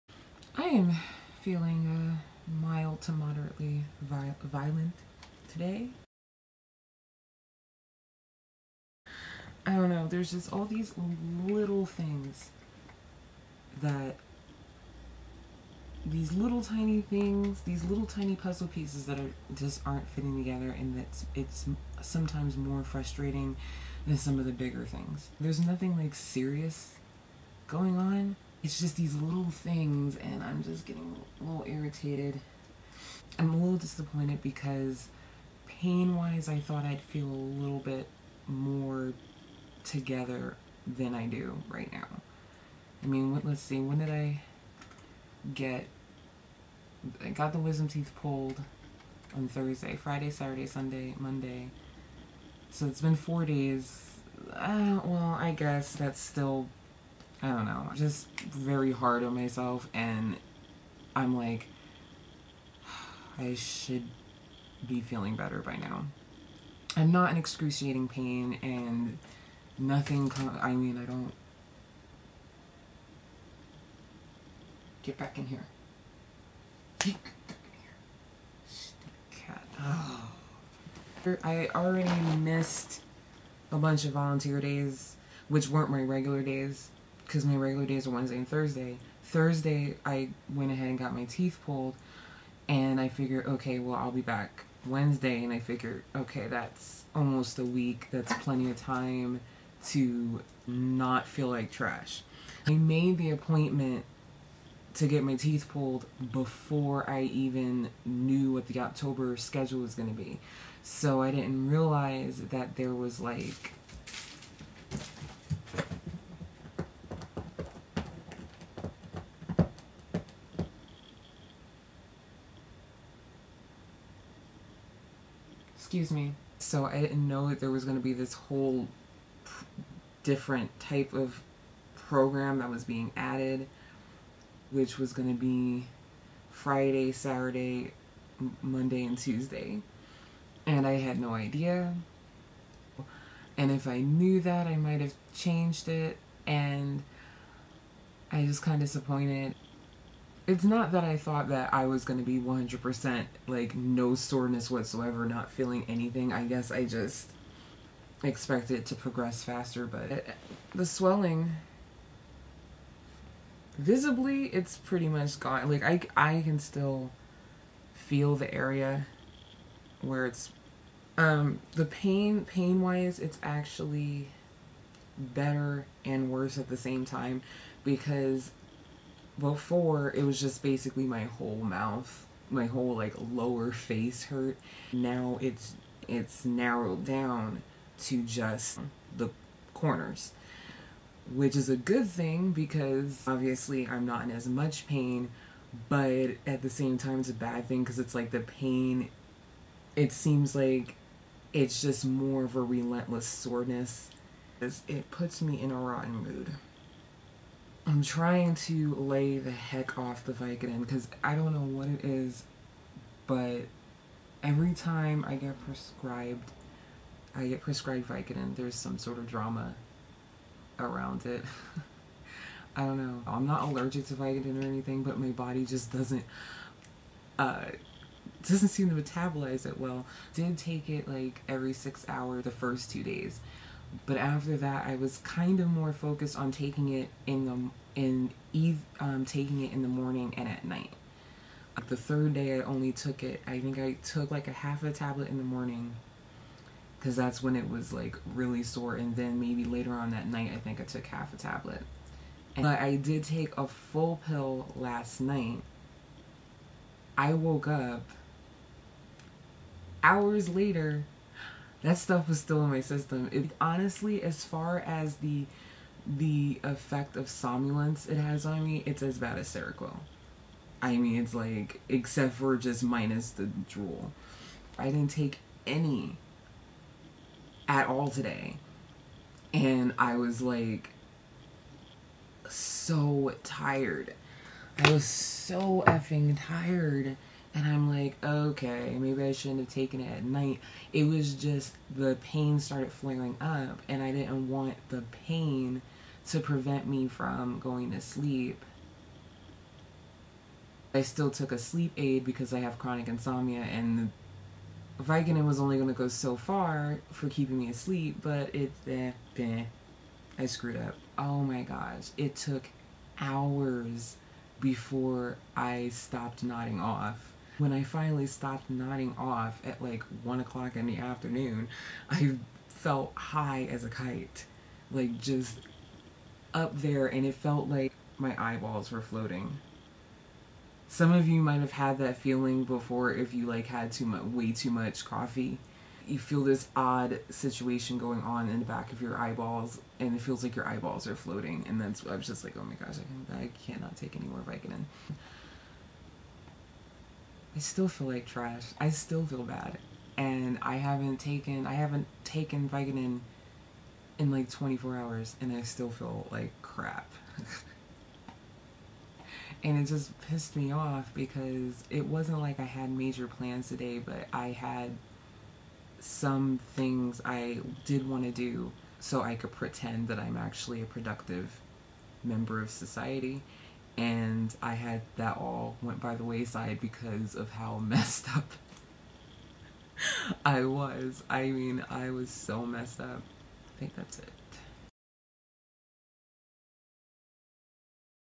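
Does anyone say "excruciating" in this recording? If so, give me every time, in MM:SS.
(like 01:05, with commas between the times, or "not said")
01:07.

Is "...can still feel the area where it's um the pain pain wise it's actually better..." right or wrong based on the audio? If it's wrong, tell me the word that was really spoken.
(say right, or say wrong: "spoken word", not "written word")
right.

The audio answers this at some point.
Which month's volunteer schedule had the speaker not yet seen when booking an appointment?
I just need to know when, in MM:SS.
01:48.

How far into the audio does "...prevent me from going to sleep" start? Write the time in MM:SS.
04:56.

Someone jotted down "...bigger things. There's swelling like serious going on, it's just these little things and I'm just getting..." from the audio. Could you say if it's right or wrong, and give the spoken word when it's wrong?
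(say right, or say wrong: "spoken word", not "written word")
wrong: "nothing", not "swelling".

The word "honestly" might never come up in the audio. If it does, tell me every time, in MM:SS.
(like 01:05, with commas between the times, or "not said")
04:23.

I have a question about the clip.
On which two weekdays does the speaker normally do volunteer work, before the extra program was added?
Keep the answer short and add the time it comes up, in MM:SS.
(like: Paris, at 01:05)
Wednesday and Thursday, at 01:28.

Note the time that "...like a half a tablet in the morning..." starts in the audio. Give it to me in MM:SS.
04:04.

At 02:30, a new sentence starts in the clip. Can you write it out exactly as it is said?
It's not that I thought that I was going to be 100% like no soreness whatsoever, not feeling anything.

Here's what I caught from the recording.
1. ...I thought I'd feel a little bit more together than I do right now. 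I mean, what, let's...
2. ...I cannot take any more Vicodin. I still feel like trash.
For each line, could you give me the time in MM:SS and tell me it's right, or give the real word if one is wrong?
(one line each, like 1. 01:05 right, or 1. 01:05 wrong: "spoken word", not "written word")
1. 00:36 right
2. 05:43 right.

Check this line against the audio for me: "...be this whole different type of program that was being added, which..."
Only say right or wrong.
right.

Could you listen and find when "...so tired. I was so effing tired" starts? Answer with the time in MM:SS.
04:42.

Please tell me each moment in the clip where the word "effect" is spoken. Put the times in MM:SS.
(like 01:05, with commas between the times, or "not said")
04:26.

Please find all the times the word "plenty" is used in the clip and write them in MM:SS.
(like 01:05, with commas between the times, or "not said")
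01:38.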